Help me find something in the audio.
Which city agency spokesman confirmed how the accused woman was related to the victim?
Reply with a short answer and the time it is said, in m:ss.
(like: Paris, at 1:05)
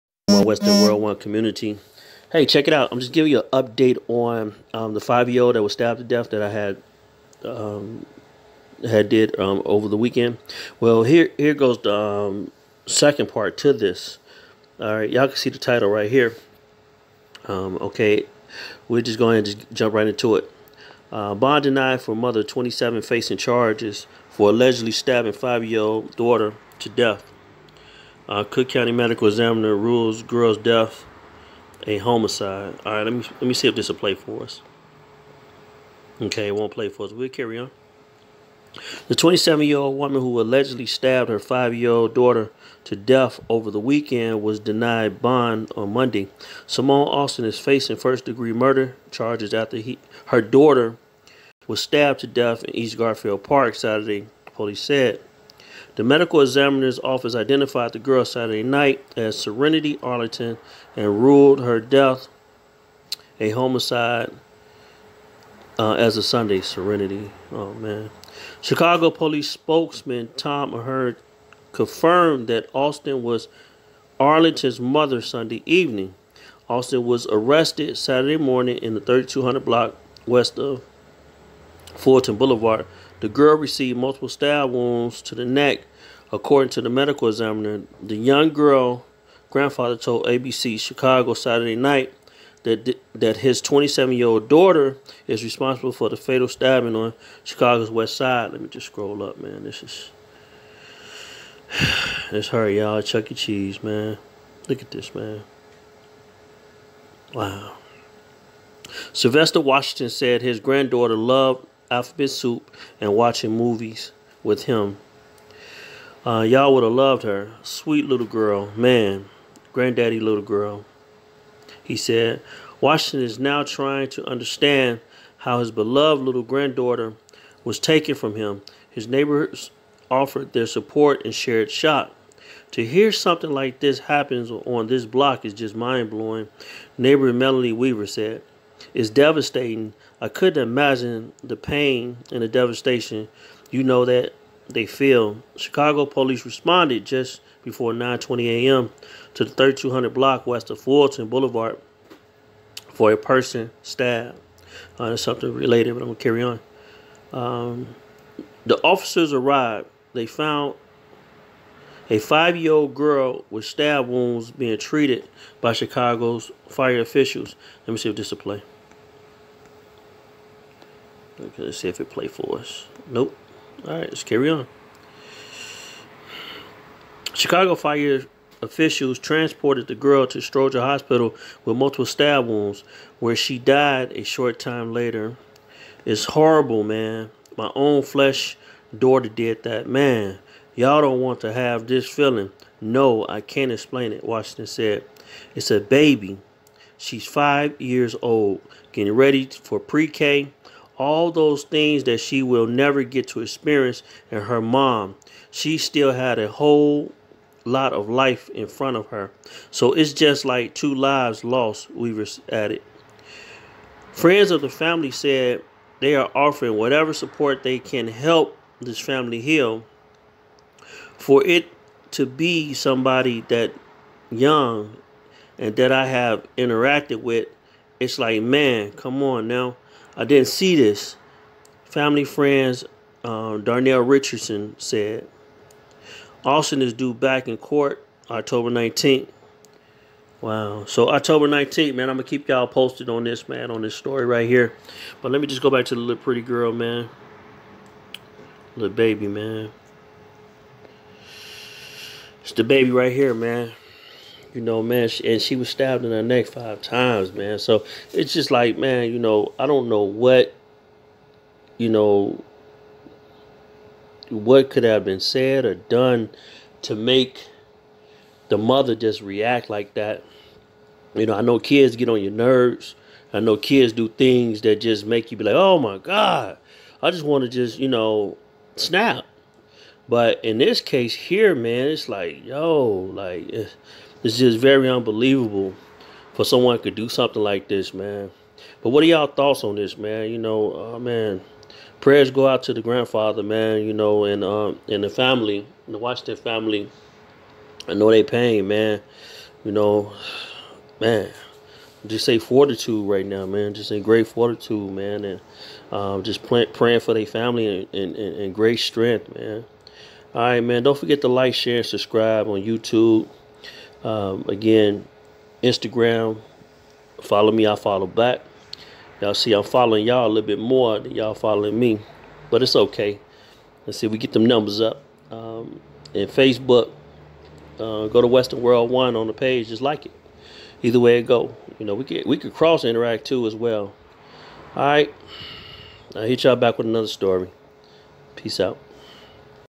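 Tom Ahern, at 1:10.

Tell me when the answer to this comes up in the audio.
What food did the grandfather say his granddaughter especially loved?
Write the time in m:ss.
1:51.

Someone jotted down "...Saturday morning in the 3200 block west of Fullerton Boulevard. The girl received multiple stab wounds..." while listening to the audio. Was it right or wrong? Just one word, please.
right.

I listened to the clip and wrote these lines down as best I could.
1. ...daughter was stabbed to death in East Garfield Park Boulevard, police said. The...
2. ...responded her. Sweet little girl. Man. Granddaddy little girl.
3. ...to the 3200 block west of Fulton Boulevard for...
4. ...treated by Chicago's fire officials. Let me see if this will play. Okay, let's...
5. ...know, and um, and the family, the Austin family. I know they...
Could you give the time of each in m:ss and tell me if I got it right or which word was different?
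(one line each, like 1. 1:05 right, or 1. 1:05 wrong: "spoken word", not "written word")
1. 0:50 wrong: "Saturday", not "Boulevard"
2. 1:56 wrong: "loved", not "responded"
3. 2:29 right
4. 2:44 right
5. 4:53 wrong: "Washington", not "Austin".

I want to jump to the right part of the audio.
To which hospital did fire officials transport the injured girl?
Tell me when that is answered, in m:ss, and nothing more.
3:00.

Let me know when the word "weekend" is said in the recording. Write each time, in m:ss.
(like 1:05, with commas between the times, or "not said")
0:09, 0:43.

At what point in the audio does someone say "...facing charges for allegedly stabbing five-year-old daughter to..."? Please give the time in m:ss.
0:23.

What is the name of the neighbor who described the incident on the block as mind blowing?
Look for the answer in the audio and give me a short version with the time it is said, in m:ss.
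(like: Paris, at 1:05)
Melanie Weaver, at 2:17.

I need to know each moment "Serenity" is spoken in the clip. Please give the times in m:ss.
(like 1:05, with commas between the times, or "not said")
0:59, 1:06.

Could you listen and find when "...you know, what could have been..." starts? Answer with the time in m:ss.
4:21.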